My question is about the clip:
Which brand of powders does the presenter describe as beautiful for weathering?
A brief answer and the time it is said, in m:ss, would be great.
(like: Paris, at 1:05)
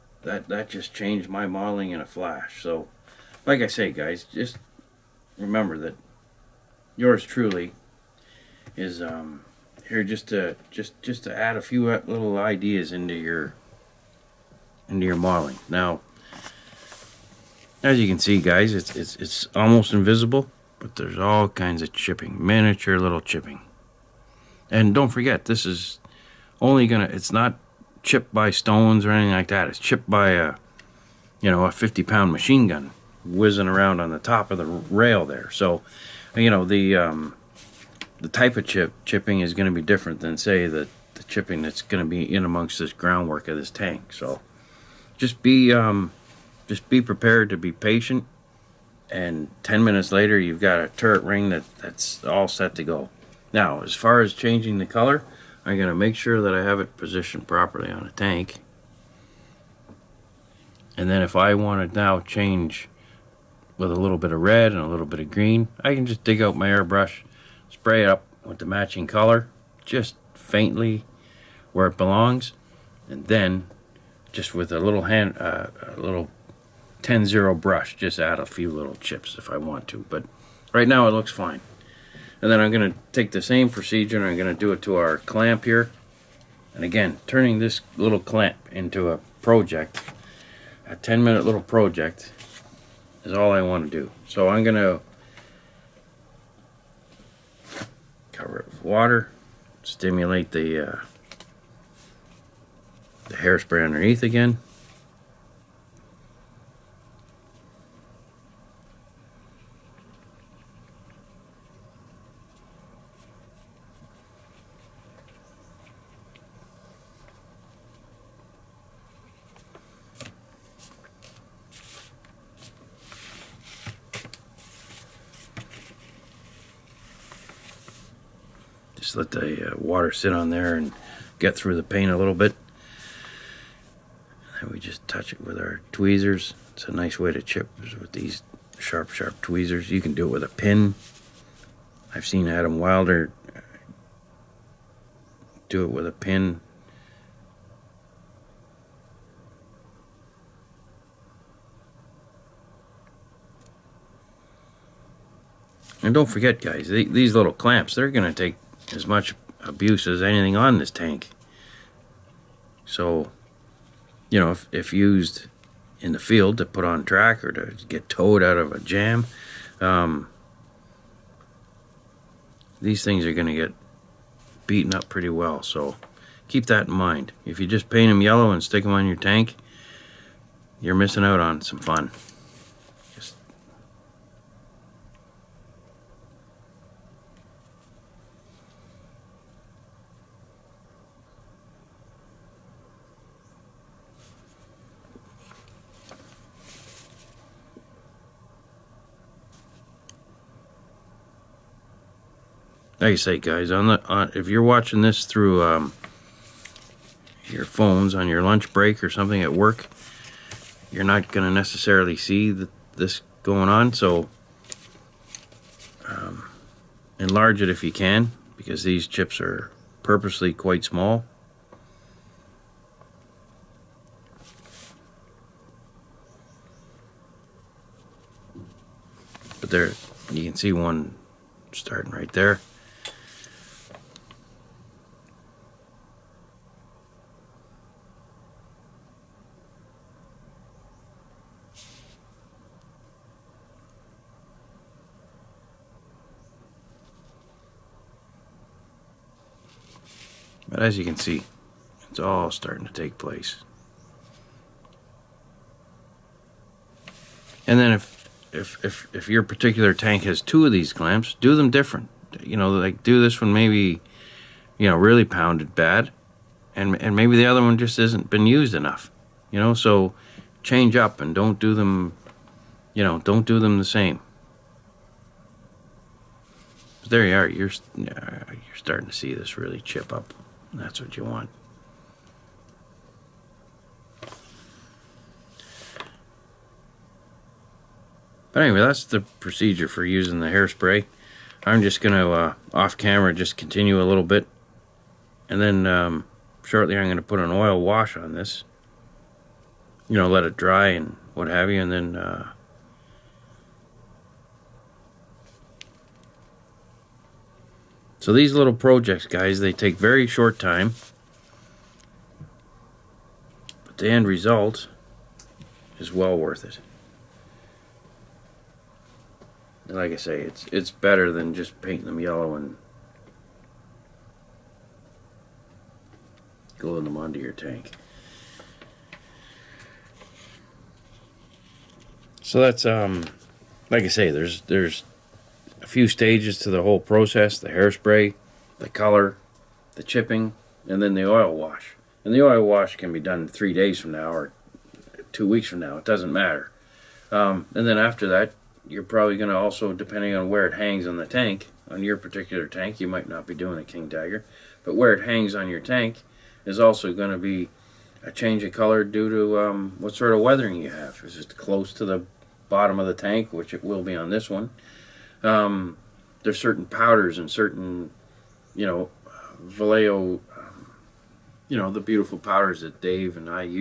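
Vallejo, at 6:09.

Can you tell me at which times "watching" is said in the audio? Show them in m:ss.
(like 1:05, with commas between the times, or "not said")
3:24.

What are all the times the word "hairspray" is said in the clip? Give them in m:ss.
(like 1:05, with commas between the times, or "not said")
1:43, 4:50, 5:37.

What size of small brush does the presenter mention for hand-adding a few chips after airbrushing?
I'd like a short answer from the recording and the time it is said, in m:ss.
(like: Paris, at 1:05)
10-0, at 1:17.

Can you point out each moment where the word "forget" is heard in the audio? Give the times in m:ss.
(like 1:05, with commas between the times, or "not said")
0:25, 2:36.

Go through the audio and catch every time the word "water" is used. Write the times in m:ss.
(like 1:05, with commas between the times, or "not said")
1:38, 2:09.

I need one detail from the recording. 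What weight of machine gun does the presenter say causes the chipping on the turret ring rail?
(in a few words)
50 pound.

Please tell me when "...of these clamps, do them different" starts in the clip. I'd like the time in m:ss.
4:20.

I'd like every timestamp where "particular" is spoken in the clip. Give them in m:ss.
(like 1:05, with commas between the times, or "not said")
4:19, 5:52.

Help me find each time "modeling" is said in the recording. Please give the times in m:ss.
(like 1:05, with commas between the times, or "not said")
0:01, 0:15.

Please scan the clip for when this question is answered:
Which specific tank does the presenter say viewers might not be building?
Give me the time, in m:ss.
5:53.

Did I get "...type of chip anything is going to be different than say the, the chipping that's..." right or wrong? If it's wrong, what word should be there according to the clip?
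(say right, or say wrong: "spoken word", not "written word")
wrong: "chipping", not "anything".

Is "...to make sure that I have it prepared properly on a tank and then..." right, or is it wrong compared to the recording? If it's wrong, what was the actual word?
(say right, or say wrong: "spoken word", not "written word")
wrong: "positioned", not "prepared".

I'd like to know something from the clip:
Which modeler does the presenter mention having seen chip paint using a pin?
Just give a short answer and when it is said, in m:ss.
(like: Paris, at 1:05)
Adam Wilder, at 2:22.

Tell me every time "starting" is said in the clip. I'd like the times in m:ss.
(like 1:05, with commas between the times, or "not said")
3:51, 4:12, 4:38.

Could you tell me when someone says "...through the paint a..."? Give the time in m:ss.
2:11.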